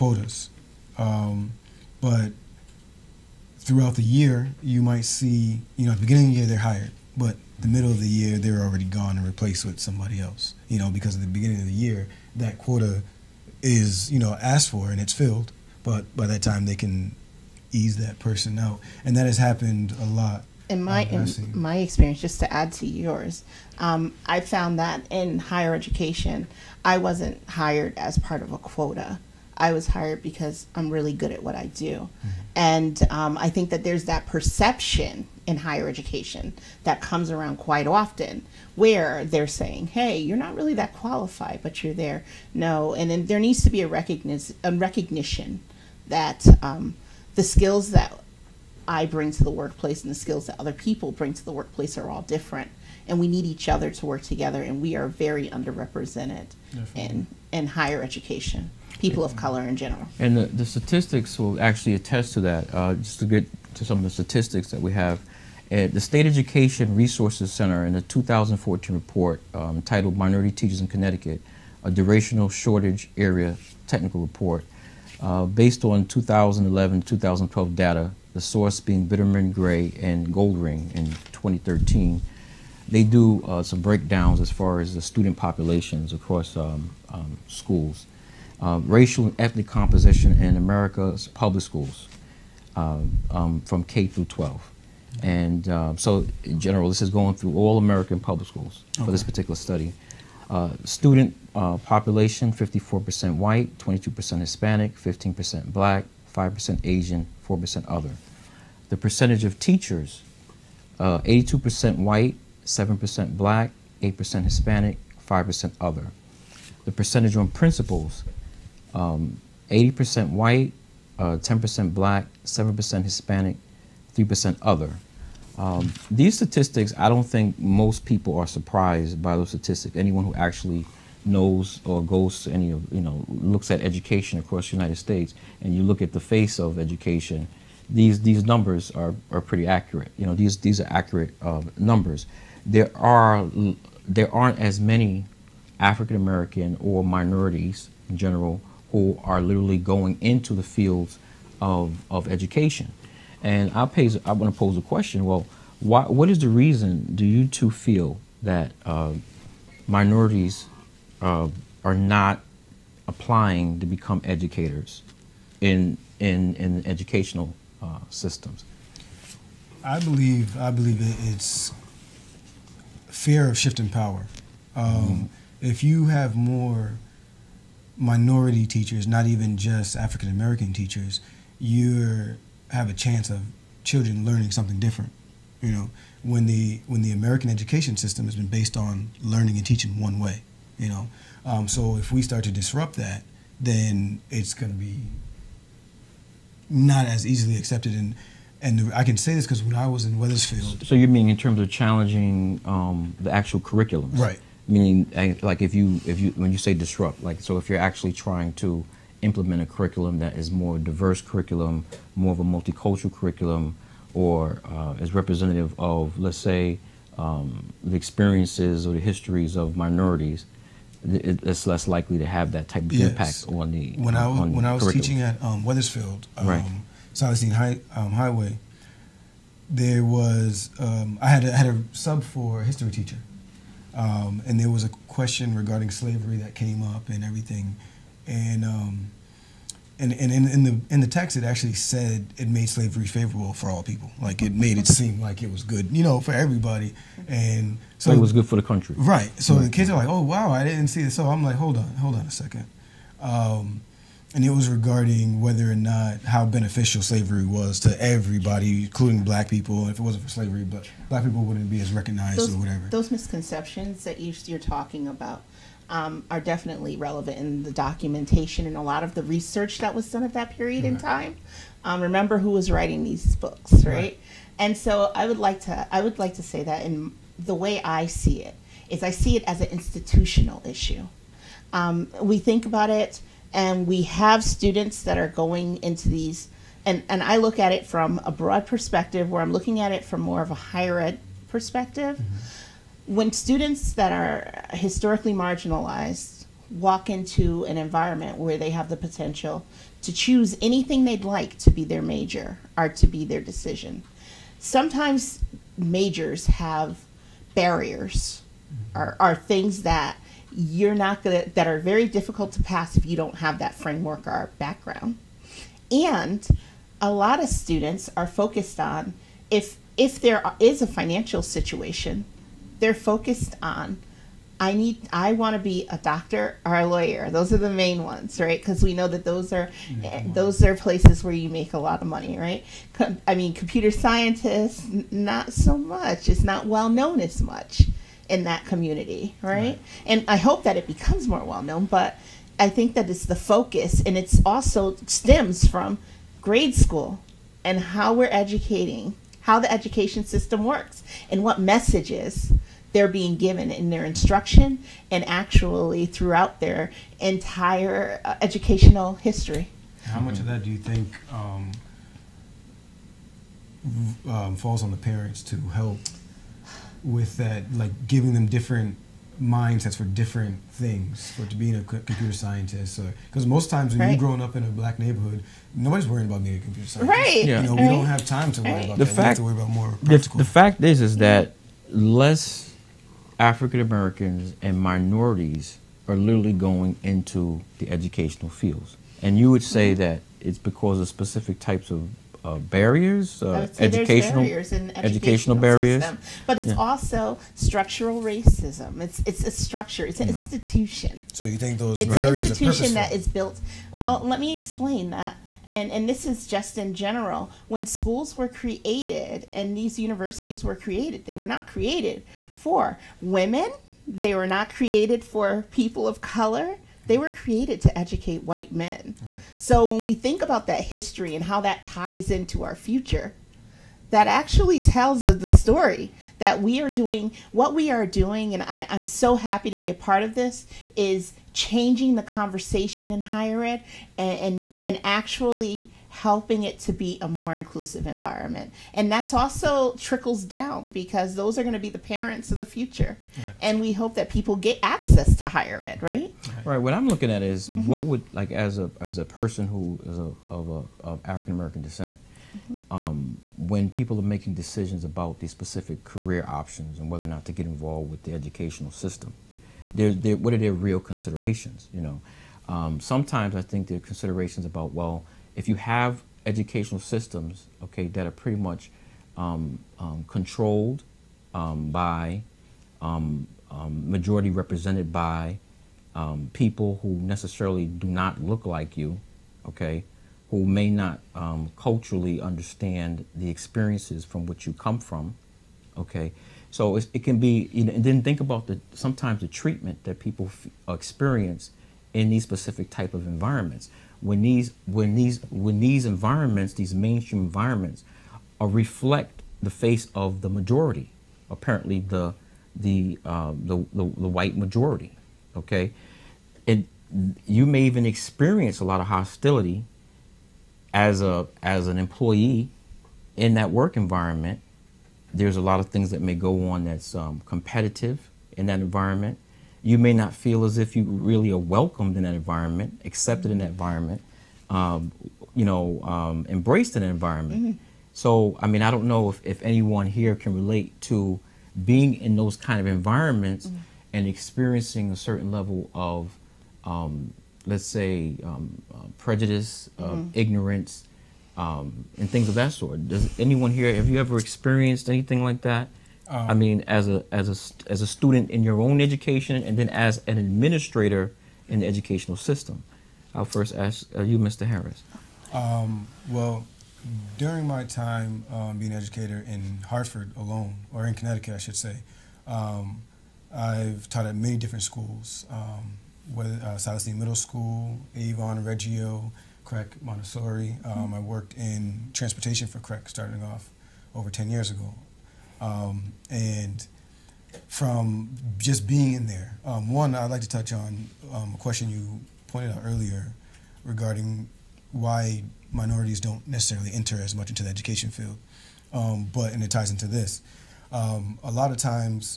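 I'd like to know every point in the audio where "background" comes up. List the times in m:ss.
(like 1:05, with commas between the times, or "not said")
5:14.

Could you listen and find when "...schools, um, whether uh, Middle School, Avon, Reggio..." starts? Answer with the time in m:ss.
9:24.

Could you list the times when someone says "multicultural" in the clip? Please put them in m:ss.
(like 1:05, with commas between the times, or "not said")
3:32.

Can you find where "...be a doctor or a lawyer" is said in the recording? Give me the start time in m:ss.
5:25.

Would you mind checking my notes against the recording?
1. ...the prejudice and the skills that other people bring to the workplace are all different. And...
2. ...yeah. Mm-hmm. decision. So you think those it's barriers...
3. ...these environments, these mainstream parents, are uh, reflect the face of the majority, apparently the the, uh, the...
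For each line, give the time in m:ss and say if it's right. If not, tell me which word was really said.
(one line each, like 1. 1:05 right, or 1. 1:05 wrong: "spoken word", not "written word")
1. 0:49 wrong: "workplace", not "prejudice"
2. 6:40 wrong: "institution", not "decision"
3. 8:15 wrong: "environments", not "parents".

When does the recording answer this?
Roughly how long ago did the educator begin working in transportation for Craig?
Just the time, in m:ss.
9:34.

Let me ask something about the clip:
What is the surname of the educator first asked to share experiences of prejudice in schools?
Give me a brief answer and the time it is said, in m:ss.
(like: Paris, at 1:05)
Harris, at 9:14.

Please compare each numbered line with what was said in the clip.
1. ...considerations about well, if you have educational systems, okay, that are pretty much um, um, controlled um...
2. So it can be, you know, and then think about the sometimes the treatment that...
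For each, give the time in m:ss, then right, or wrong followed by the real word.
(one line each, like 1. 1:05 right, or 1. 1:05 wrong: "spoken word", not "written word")
1. 7:44 right
2. 8:06 right.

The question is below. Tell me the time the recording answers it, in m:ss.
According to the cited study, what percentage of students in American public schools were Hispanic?
1:43.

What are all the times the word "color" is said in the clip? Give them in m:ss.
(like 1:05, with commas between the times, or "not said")
0:59, 6:56.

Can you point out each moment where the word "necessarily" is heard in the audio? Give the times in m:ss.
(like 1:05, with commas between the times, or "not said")
7:57, 9:46.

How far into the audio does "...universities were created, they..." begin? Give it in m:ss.
6:49.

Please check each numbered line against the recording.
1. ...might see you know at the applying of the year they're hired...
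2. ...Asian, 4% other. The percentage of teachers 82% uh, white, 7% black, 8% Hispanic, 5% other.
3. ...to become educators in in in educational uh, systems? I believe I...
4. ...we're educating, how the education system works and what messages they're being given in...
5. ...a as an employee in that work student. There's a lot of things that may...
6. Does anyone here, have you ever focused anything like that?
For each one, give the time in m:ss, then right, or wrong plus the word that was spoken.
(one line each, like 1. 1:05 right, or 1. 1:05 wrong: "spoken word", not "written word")
1. 0:04 wrong: "beginning", not "applying"
2. 1:46 right
3. 2:43 right
4. 5:48 right
5. 8:31 wrong: "environment", not "student"
6. 9:03 wrong: "experienced", not "focused".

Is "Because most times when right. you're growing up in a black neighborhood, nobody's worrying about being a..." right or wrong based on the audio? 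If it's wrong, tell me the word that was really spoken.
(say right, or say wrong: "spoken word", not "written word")
right.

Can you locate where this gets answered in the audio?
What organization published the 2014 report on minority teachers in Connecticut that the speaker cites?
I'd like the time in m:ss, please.
1:05.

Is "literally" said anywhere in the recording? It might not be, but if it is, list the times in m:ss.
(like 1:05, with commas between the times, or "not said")
2:29, 6:26.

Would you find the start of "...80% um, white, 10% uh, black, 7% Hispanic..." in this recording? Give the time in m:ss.
1:58.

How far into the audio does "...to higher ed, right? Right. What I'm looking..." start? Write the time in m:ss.
7:25.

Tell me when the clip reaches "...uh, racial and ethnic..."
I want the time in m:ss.
1:28.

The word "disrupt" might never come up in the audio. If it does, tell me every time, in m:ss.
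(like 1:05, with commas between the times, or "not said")
3:12, 3:26.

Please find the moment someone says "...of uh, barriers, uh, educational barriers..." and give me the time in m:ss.
6:31.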